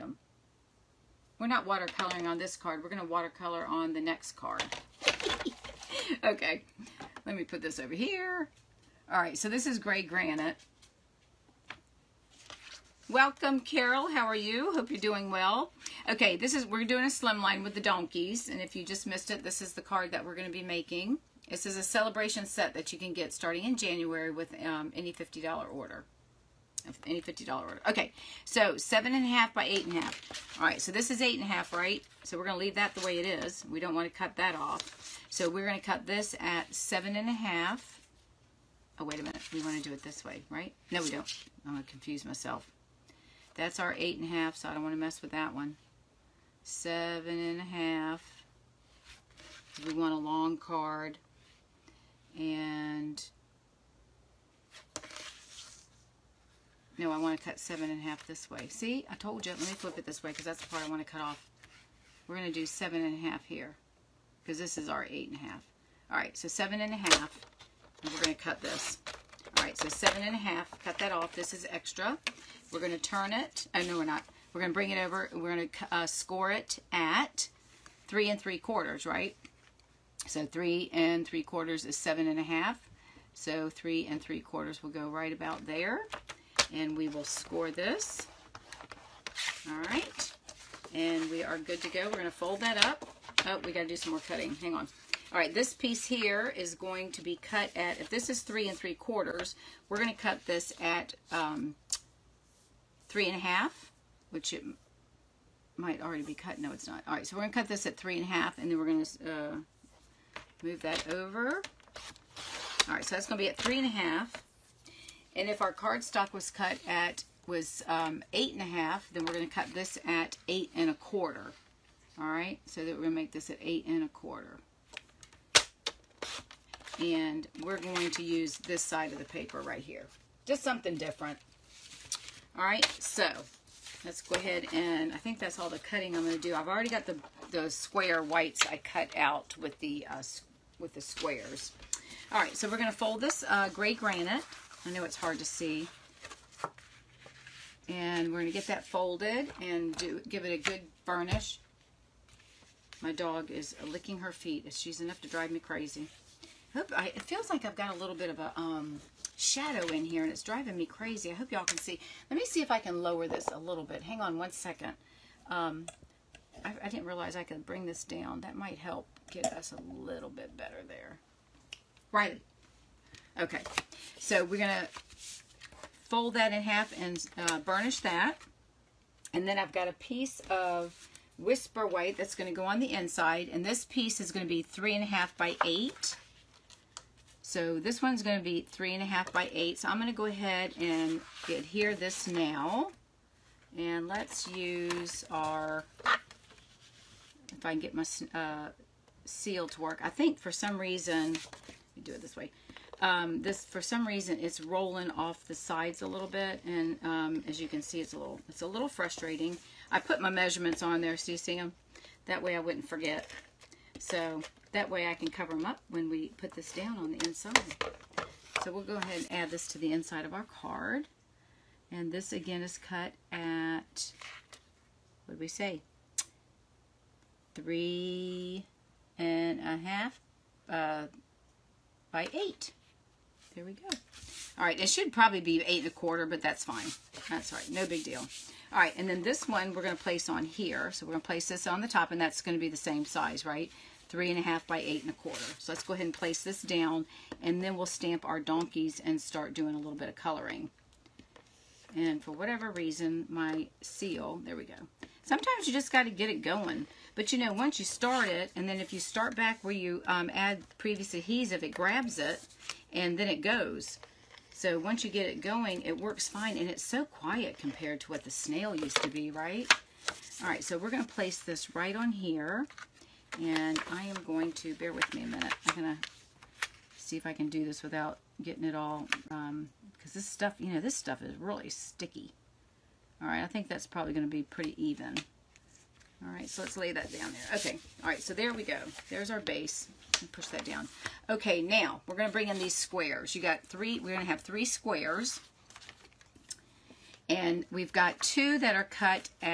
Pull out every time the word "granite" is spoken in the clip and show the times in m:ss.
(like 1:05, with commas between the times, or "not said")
0:10, 2:23.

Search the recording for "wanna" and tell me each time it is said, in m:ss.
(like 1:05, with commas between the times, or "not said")
0:33, 0:39, 0:44.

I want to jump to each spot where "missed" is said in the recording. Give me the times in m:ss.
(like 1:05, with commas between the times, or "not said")
0:19.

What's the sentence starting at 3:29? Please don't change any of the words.
I put my measurements on there, so you see them?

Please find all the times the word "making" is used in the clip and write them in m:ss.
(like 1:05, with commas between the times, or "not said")
0:20.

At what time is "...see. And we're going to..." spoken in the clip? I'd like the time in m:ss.
2:25.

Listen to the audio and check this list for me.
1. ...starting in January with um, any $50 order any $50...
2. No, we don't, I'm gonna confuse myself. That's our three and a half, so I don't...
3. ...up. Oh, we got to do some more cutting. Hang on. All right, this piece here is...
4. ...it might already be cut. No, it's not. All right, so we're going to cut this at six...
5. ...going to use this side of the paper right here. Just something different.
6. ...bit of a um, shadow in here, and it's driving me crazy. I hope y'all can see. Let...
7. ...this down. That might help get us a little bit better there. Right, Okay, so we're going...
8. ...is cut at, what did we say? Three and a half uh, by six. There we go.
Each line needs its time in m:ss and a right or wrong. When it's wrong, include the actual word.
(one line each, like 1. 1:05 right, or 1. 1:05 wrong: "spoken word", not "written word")
1. 0:23 right
2. 0:40 wrong: "eight", not "three"
3. 1:32 right
4. 1:44 wrong: "three", not "six"
5. 2:07 right
6. 2:38 right
7. 2:47 right
8. 3:42 wrong: "eight", not "six".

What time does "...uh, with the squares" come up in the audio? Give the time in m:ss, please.
2:20.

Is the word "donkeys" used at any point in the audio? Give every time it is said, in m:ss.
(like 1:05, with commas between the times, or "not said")
0:17, 4:08.